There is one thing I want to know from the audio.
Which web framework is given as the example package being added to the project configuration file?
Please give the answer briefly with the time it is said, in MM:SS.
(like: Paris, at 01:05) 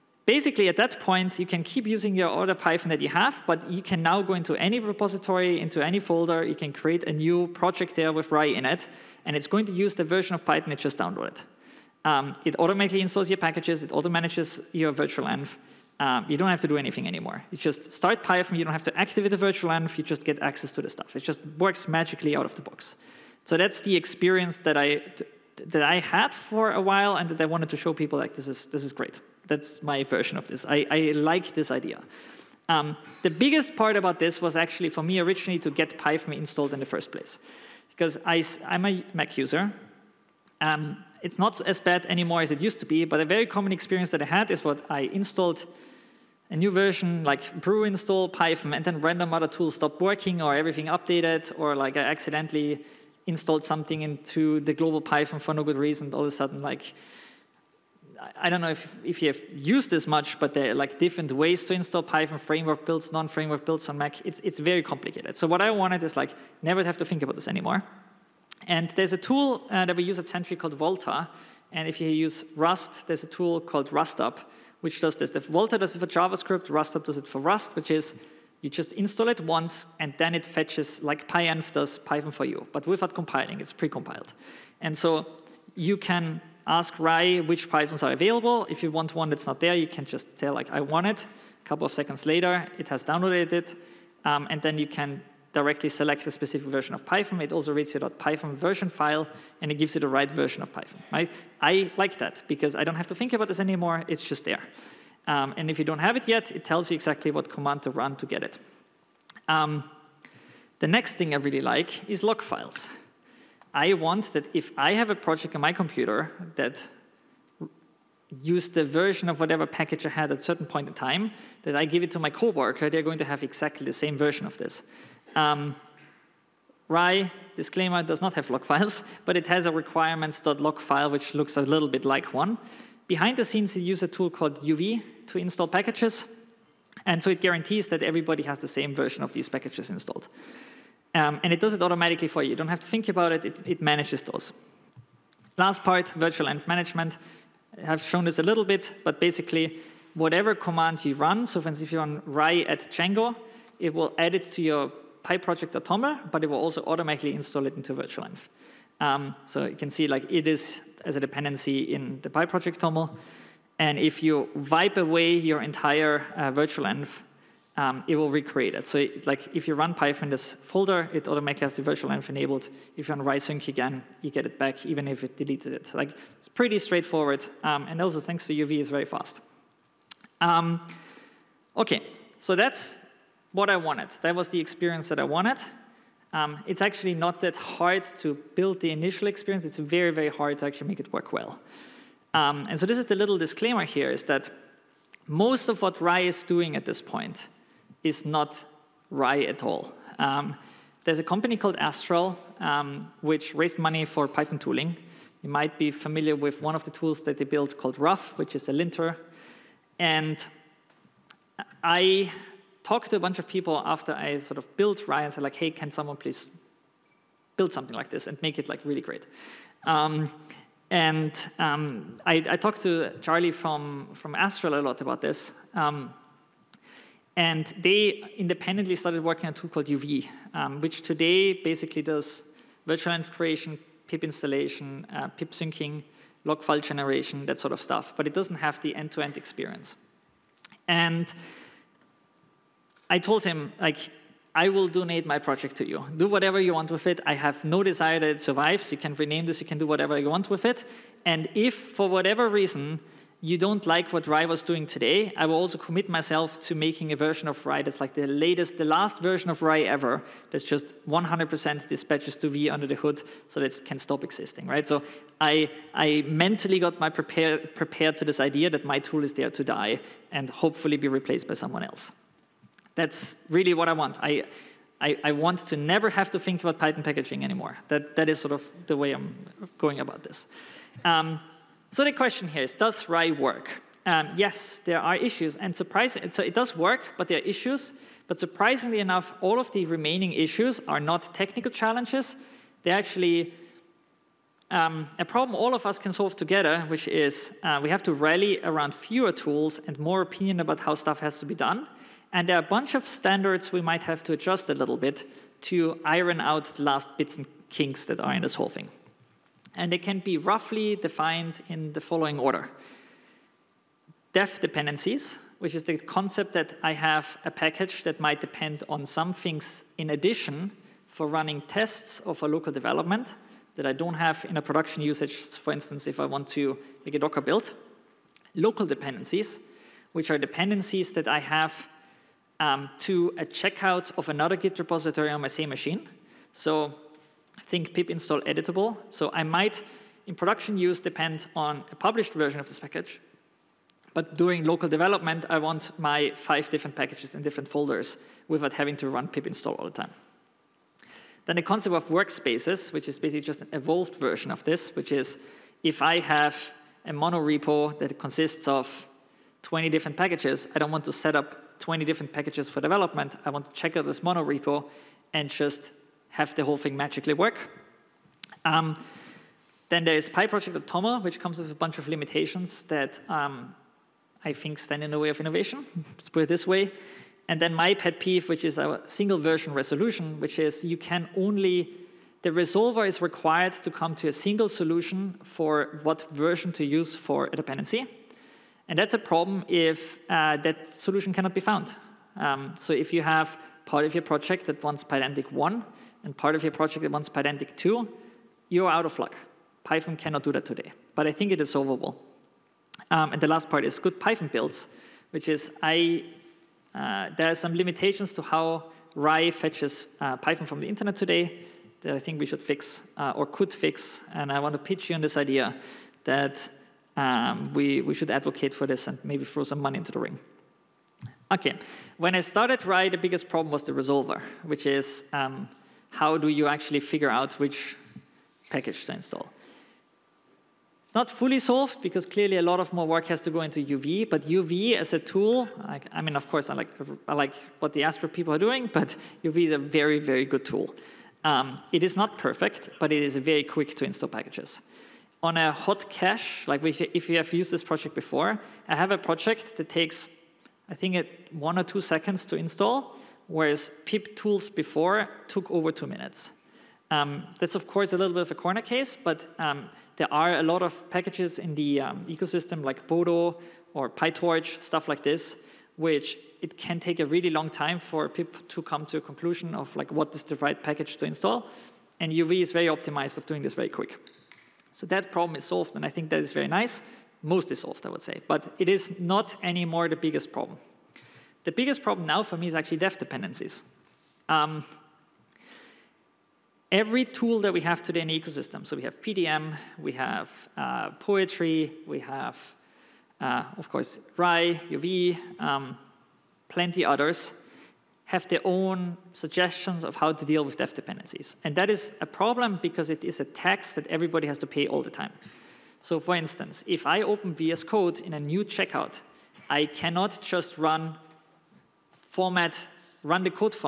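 Django, at 02:32.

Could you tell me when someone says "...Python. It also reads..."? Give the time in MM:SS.
01:37.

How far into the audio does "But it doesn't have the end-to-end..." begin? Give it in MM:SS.
03:58.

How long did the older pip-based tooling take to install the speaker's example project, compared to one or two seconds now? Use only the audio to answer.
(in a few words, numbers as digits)
over 2 minutes.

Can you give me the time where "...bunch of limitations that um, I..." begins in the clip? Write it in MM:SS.
06:11.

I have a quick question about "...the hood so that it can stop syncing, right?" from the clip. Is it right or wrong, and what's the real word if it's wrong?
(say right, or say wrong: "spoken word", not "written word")
wrong: "existing", not "syncing".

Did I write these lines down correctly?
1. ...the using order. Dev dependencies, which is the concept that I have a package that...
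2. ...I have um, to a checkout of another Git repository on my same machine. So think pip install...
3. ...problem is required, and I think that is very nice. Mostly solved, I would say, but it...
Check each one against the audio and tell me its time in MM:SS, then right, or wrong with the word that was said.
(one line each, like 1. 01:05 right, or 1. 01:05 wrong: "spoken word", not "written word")
1. 05:11 wrong: "following", not "using"
2. 05:31 right
3. 07:55 wrong: "solved", not "required".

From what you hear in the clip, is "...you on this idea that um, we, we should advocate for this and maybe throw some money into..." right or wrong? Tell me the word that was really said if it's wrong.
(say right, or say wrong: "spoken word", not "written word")
right.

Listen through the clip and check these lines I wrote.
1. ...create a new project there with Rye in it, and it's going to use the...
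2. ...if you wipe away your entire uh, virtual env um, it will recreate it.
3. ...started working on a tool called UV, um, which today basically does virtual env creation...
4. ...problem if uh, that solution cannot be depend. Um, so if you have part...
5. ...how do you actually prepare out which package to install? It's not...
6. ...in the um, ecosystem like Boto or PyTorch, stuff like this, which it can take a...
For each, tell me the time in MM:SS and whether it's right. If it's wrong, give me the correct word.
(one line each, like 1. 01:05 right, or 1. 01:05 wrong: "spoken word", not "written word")
1. 00:06 right
2. 02:43 right
3. 03:48 right
4. 06:29 wrong: "found", not "depend"
5. 07:06 wrong: "figure", not "prepare"
6. 07:41 right.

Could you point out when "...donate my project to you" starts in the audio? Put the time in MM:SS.
04:04.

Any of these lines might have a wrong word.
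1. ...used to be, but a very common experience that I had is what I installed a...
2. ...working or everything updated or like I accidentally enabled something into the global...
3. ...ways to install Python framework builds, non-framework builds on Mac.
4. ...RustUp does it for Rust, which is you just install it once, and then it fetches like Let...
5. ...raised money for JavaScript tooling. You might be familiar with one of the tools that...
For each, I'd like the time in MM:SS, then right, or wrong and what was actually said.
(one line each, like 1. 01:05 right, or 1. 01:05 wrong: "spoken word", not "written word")
1. 00:42 right
2. 00:49 wrong: "installed", not "enabled"
3. 01:01 right
4. 01:16 wrong: "PyEnv", not "Let"
5. 03:23 wrong: "Python", not "JavaScript".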